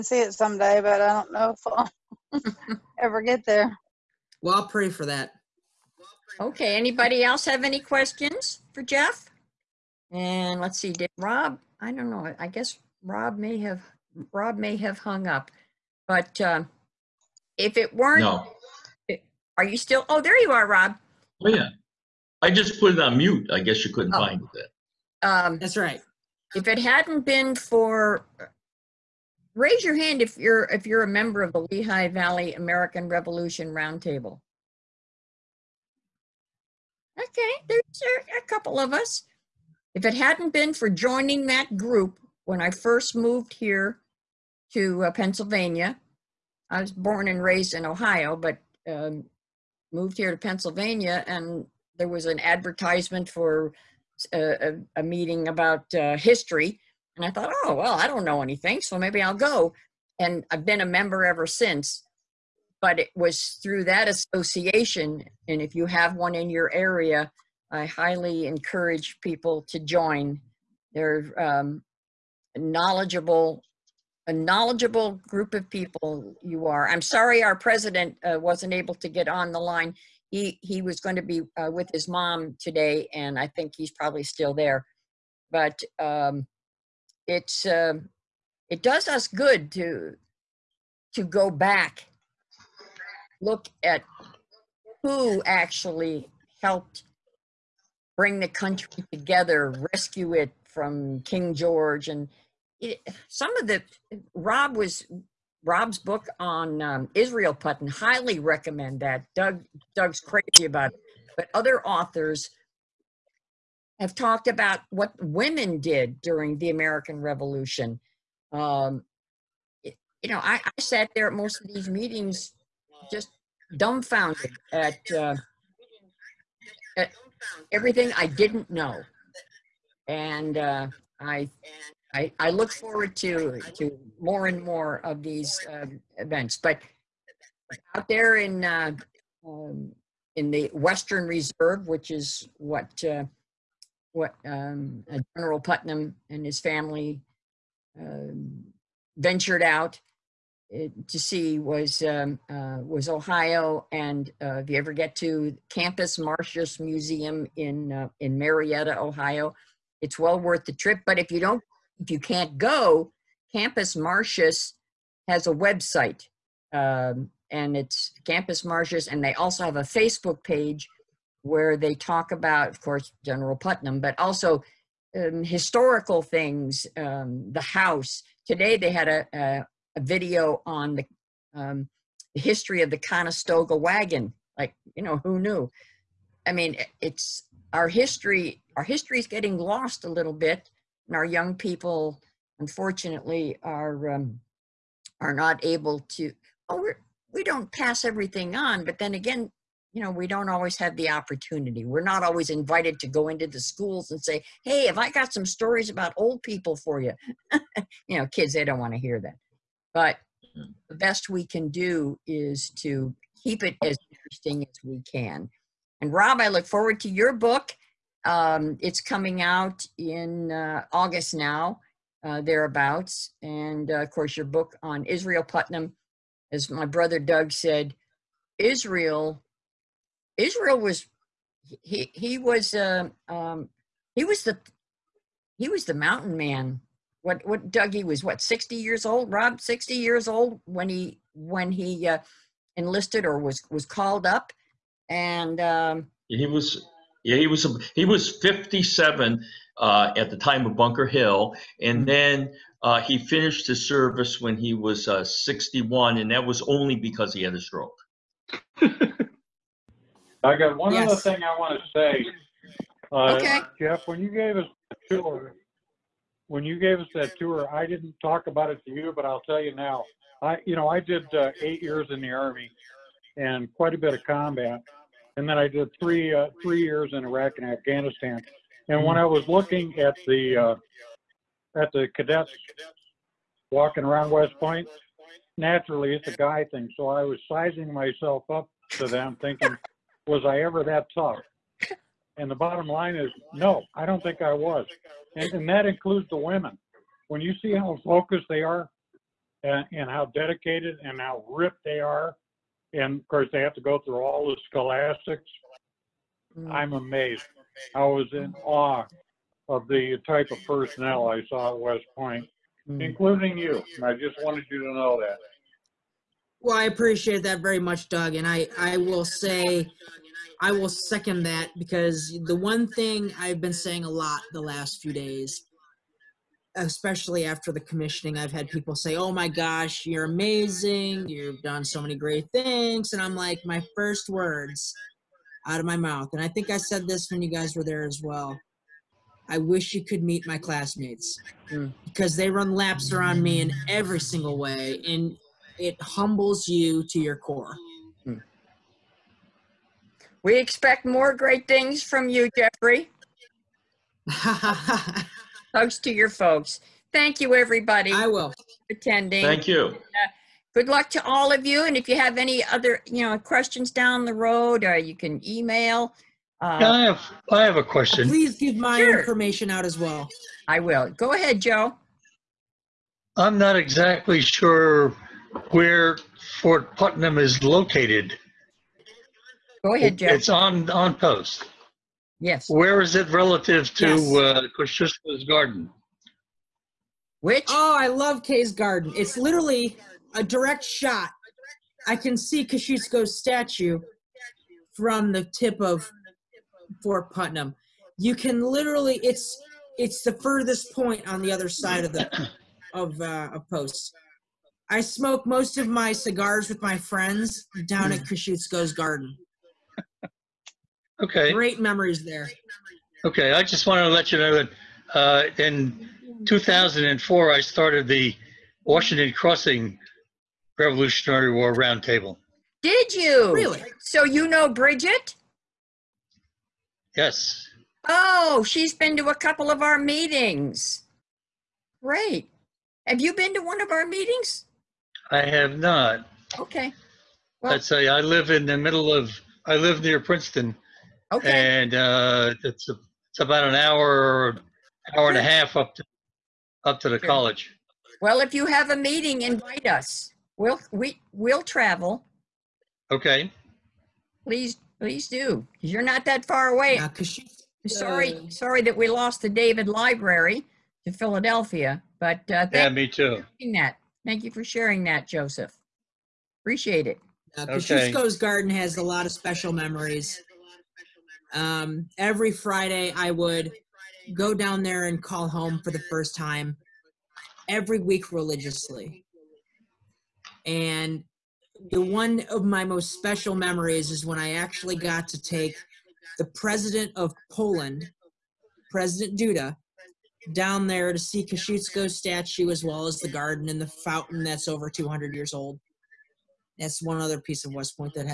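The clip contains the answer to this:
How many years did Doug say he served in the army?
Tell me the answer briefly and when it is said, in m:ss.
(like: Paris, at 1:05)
8, at 4:31.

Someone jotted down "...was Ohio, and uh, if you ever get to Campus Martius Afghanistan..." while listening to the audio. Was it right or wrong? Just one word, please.
wrong.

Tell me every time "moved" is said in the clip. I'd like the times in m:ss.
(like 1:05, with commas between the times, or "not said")
0:43, 0:49.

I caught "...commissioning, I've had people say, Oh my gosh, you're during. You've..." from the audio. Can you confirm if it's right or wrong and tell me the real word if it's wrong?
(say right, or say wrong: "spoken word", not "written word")
wrong: "amazing", not "during".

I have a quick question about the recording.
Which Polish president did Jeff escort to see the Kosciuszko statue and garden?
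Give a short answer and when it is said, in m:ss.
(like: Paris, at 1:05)
President Duda, at 8:08.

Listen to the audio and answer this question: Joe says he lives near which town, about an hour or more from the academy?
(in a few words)
Princeton.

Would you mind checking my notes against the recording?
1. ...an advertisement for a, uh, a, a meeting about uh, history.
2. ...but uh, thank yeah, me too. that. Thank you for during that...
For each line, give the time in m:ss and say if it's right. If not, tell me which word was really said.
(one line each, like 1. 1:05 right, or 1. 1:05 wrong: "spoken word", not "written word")
1. 0:52 right
2. 7:42 wrong: "sharing", not "during".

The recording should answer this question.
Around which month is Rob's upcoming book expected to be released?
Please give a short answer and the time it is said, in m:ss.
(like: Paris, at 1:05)
August, at 3:40.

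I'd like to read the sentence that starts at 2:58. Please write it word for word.
Today they had a, a a video on the, um, the history of the Conestoga wagon.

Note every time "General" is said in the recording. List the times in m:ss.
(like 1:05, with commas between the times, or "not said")
2:25, 2:53.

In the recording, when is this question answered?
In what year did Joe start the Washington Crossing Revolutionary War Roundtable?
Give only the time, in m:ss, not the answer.
6:56.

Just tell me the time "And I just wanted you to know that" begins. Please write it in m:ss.
5:13.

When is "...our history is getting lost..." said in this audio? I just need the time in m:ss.
3:08.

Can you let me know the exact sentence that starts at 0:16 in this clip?
But uh, if it weren't, No, are you still, oh, there you are, Rob.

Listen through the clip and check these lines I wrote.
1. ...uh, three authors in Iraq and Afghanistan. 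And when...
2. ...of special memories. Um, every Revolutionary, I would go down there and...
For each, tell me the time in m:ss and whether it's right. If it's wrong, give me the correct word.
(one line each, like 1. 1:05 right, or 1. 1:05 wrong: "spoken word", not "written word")
1. 4:36 wrong: "years", not "authors"
2. 7:49 wrong: "Friday", not "Revolutionary".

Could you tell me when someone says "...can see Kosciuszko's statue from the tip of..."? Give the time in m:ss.
6:32.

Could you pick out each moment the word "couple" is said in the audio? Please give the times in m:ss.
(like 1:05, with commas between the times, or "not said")
0:38, 7:09.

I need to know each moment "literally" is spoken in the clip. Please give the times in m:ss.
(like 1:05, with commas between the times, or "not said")
6:29, 6:38.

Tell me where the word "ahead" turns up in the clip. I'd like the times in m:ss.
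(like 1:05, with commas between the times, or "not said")
6:11, 6:19.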